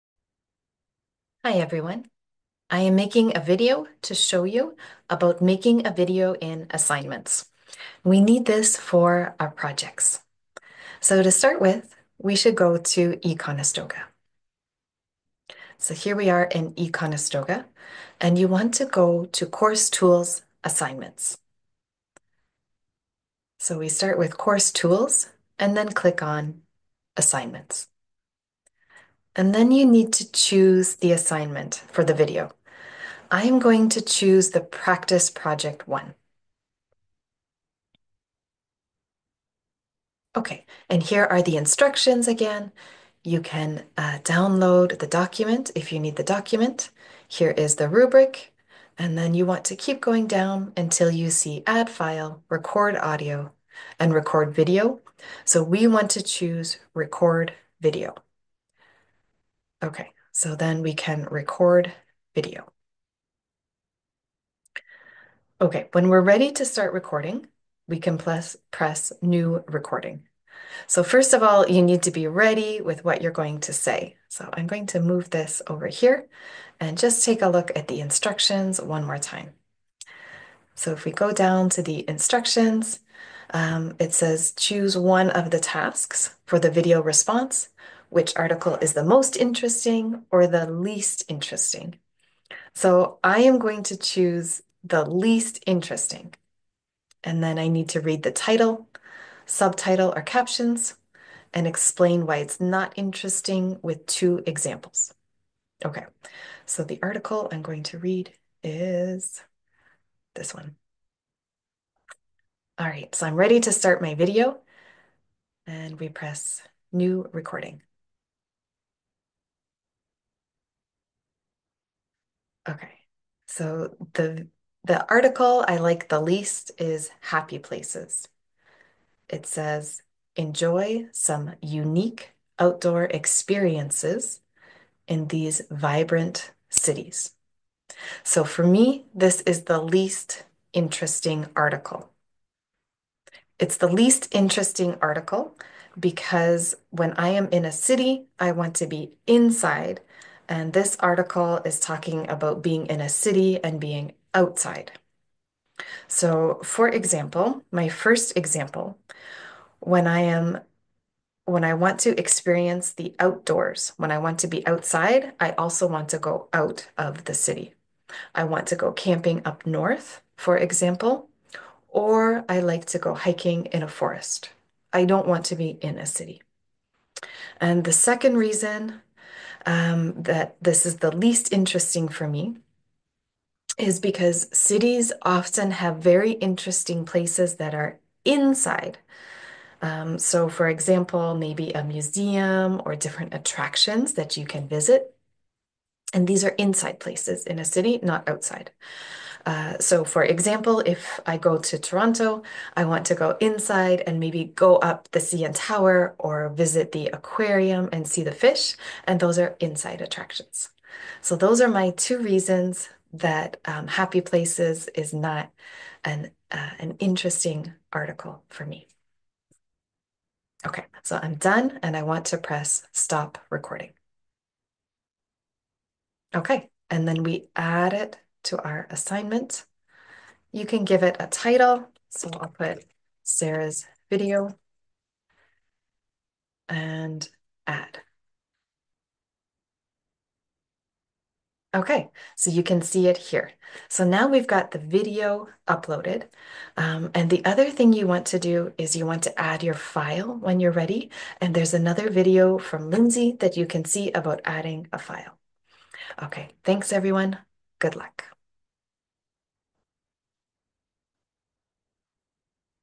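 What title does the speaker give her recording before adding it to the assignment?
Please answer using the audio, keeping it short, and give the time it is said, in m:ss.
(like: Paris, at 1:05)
Sarah's video, at 3:53.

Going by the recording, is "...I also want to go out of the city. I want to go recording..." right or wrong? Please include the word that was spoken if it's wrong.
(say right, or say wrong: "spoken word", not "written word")
wrong: "camping", not "recording".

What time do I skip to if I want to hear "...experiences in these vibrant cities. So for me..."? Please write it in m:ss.
2:13.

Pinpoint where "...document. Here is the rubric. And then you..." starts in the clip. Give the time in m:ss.
0:46.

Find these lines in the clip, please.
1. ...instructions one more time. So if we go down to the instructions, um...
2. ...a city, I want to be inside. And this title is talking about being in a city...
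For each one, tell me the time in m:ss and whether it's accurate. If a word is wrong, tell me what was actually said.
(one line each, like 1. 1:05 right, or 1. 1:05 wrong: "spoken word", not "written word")
1. 1:18 right
2. 2:27 wrong: "article", not "title".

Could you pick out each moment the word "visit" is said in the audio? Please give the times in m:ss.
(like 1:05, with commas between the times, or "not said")
3:14, 3:26.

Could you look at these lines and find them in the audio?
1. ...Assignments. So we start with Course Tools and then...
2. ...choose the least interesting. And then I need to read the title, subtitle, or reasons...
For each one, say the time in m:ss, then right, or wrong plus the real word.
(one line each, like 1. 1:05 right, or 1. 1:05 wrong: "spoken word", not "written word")
1. 0:20 right
2. 1:33 wrong: "captions", not "reasons".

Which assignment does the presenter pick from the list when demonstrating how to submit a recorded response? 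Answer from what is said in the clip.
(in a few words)
practice project one.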